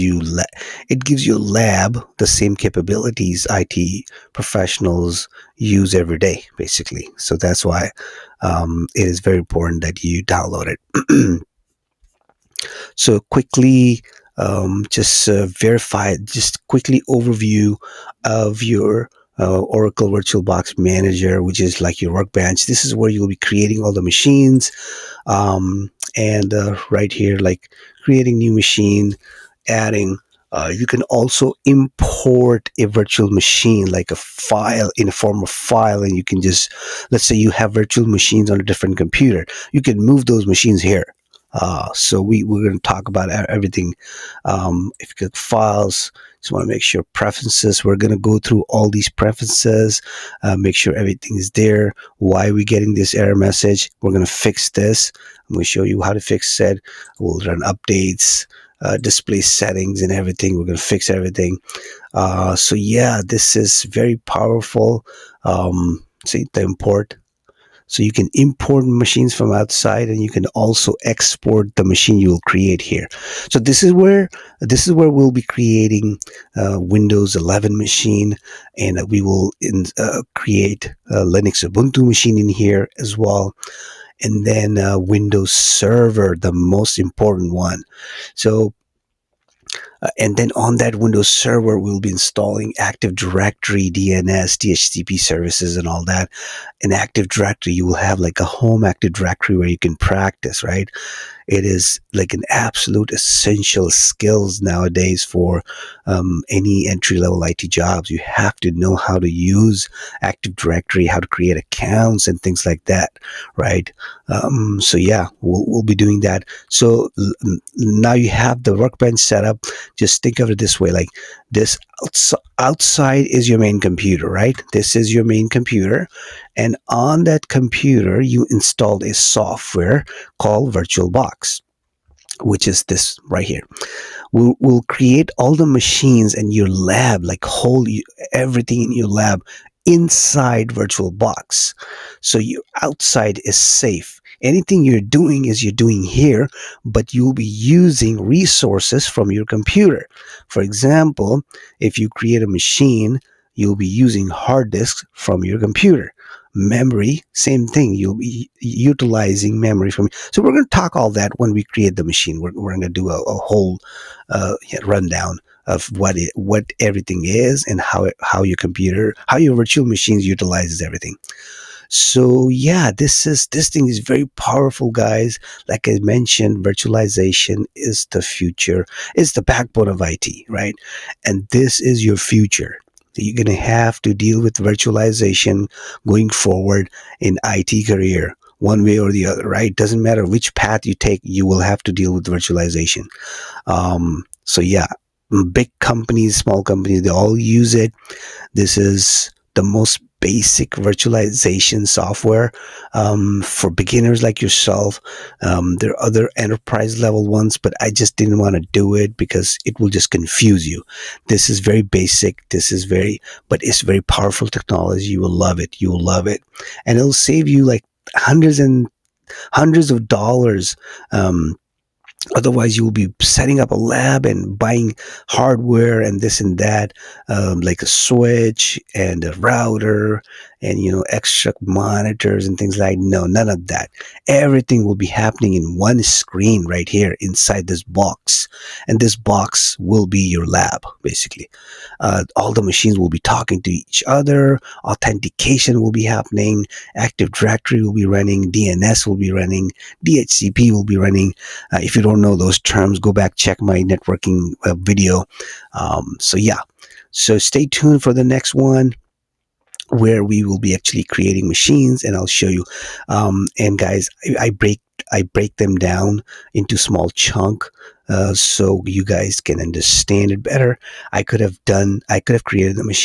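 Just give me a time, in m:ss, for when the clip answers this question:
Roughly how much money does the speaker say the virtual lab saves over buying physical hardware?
3:38.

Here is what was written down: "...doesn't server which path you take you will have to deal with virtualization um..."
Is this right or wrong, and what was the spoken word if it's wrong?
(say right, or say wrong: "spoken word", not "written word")
wrong: "matter", not "server".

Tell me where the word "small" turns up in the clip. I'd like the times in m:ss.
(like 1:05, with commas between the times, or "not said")
3:16, 4:26.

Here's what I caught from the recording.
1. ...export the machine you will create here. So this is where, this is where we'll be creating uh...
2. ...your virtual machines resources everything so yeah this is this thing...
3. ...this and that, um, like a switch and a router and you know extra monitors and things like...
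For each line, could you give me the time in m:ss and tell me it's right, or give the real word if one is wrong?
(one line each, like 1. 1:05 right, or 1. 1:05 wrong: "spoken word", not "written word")
1. 1:11 right
2. 2:49 wrong: "utilizes", not "resources"
3. 3:46 right.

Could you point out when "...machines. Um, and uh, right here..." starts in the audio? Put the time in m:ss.
0:24.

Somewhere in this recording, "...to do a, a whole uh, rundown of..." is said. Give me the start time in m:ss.
2:42.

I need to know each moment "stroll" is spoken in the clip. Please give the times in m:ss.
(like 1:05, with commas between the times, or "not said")
not said.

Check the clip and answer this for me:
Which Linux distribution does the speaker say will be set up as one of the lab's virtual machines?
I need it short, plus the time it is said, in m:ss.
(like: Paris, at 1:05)
Ubuntu, at 1:21.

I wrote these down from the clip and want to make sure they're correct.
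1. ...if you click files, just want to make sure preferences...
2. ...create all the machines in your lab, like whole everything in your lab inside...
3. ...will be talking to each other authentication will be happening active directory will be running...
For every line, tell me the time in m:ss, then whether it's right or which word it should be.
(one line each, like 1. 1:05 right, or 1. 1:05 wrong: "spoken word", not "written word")
1. 0:44 right
2. 2:14 right
3. 4:02 right.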